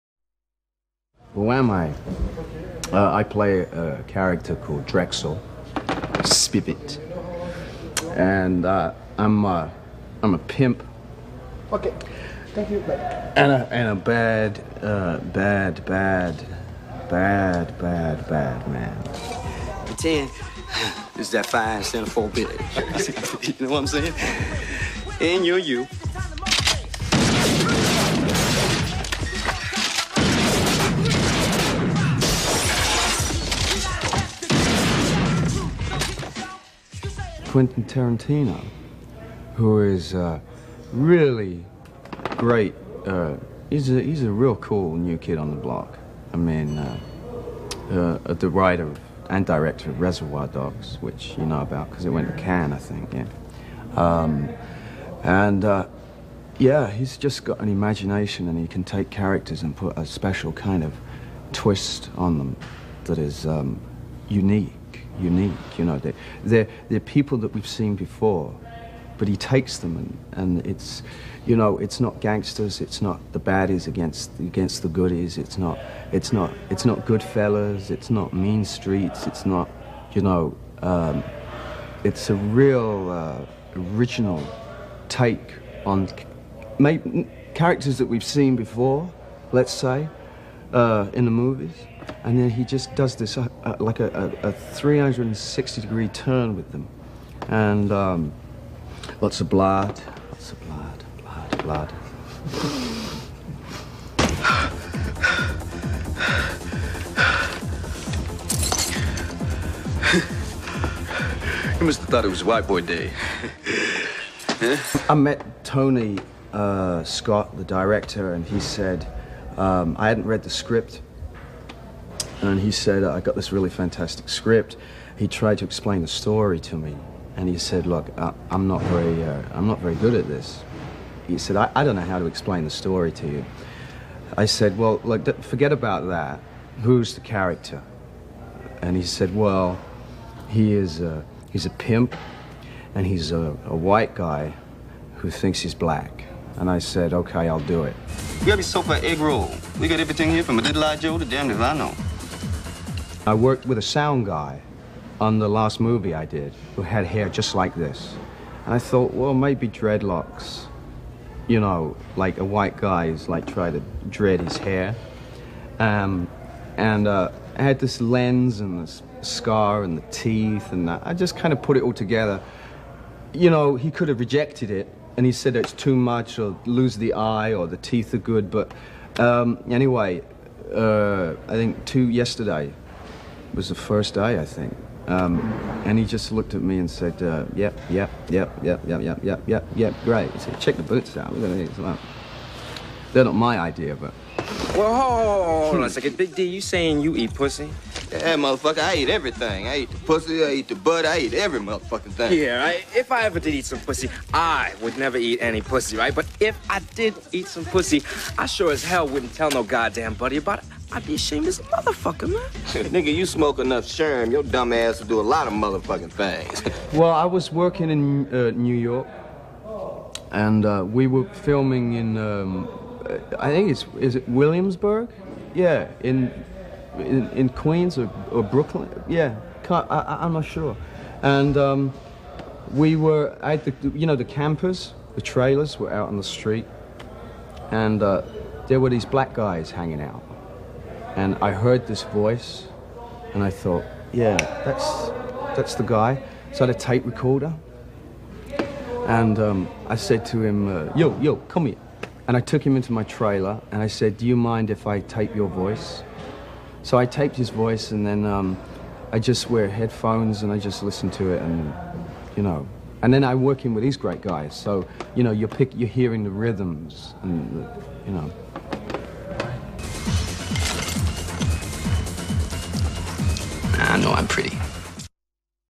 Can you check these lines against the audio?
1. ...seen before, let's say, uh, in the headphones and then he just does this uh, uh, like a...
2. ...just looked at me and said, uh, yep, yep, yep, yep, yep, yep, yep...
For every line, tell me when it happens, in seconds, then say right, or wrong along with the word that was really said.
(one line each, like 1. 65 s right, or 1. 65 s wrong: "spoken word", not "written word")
1. 88 s wrong: "movies", not "headphones"
2. 186 s right.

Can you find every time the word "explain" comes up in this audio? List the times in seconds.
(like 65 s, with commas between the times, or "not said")
125 s, 132 s.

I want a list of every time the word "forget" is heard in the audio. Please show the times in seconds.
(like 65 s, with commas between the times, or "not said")
135 s.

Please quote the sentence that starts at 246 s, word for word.
So I had a tape recorder, and um, I said to him, uh, yo, yo, come here.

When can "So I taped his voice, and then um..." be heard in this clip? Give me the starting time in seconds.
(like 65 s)
256 s.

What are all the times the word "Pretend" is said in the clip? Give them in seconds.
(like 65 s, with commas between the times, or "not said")
19 s.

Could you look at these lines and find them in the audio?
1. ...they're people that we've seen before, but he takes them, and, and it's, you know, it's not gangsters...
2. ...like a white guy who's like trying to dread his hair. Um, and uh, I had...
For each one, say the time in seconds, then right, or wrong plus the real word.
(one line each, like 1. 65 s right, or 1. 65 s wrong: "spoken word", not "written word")
1. 66 s right
2. 162 s right.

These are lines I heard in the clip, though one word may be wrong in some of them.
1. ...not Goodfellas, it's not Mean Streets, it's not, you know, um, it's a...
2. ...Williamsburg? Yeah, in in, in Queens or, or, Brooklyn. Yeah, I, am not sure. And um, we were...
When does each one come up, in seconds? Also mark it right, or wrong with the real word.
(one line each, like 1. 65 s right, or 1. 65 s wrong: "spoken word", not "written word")
1. 76 s right
2. 224 s right.